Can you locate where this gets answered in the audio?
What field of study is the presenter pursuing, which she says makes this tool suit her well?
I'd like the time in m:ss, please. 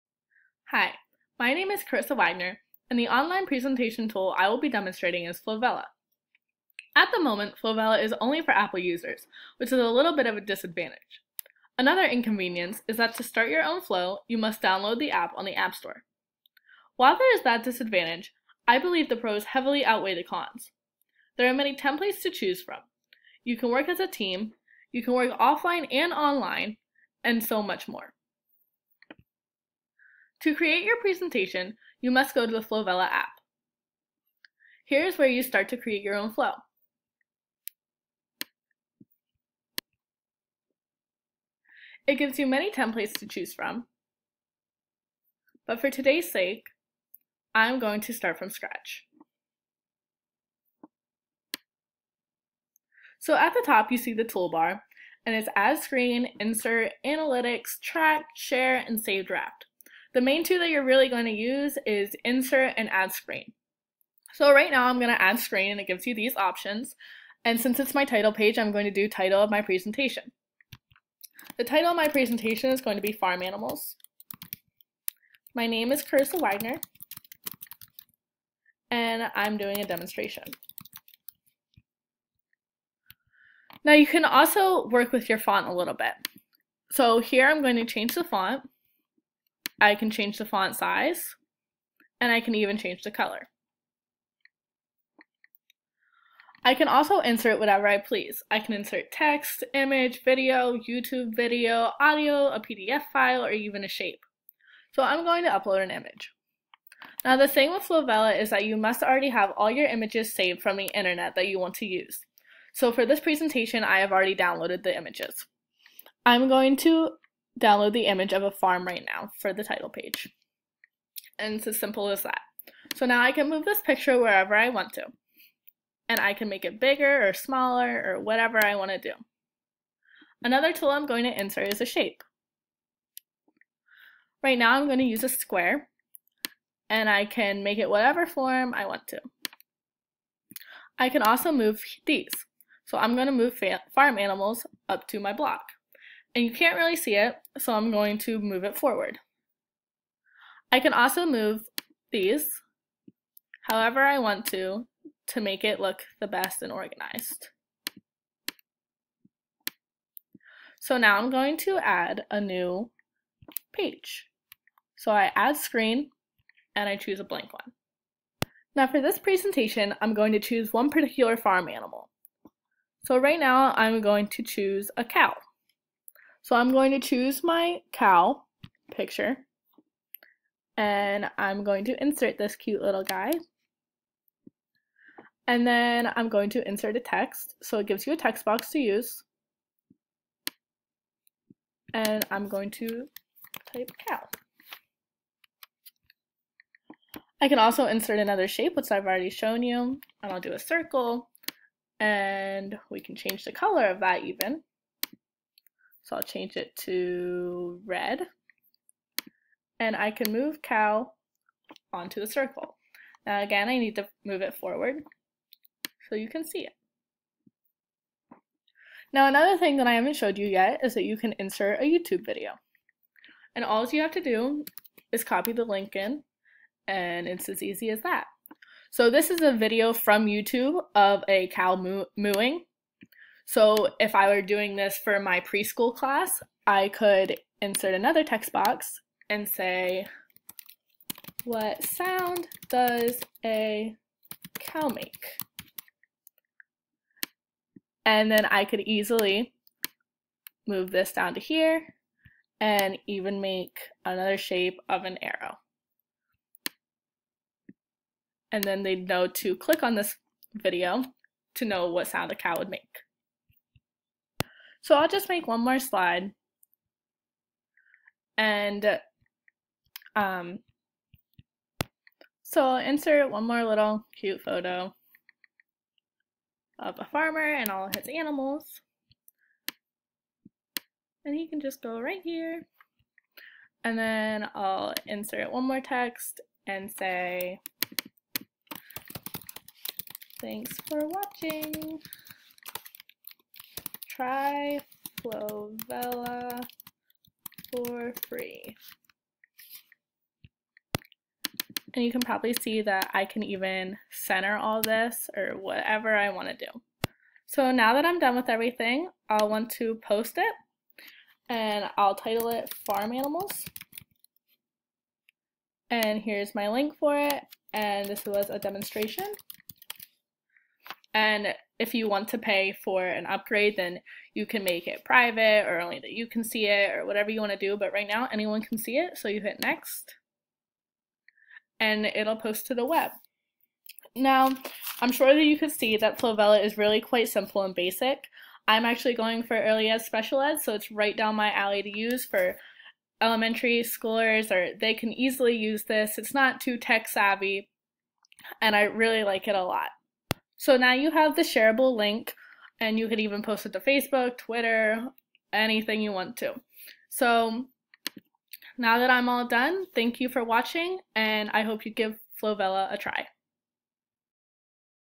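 5:39.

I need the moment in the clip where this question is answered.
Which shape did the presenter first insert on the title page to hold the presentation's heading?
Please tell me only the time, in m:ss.
2:15.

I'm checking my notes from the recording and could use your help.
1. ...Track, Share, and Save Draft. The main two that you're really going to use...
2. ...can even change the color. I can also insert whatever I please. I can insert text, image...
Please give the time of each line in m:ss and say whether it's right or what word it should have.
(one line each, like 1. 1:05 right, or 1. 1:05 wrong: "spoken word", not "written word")
1. 0:57 right
2. 1:32 right.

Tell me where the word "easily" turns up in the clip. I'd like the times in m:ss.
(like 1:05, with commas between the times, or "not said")
4:08, 5:45.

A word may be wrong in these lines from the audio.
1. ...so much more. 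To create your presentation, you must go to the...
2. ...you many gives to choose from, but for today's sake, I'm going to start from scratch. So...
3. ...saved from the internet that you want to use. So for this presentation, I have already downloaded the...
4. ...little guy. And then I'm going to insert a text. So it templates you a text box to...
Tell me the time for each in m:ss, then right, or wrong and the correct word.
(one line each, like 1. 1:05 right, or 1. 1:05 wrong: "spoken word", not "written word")
1. 0:27 right
2. 0:42 wrong: "templates", not "gives"
3. 1:50 right
4. 3:02 wrong: "gives", not "templates".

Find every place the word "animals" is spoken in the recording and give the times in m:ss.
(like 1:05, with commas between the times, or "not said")
1:13, 2:24, 2:51, 4:38, 5:13.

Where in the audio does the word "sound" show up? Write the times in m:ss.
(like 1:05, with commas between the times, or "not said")
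4:01, 4:22.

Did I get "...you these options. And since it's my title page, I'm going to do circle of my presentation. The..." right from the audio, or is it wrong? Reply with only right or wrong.
wrong.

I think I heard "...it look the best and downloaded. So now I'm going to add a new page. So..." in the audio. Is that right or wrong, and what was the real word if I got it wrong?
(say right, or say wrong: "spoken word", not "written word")
wrong: "organized", not "downloaded".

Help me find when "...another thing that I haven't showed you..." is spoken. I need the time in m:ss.
3:39.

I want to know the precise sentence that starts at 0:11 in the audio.
Another inconvenience is that to start your own flow, you must download the app on the App Store.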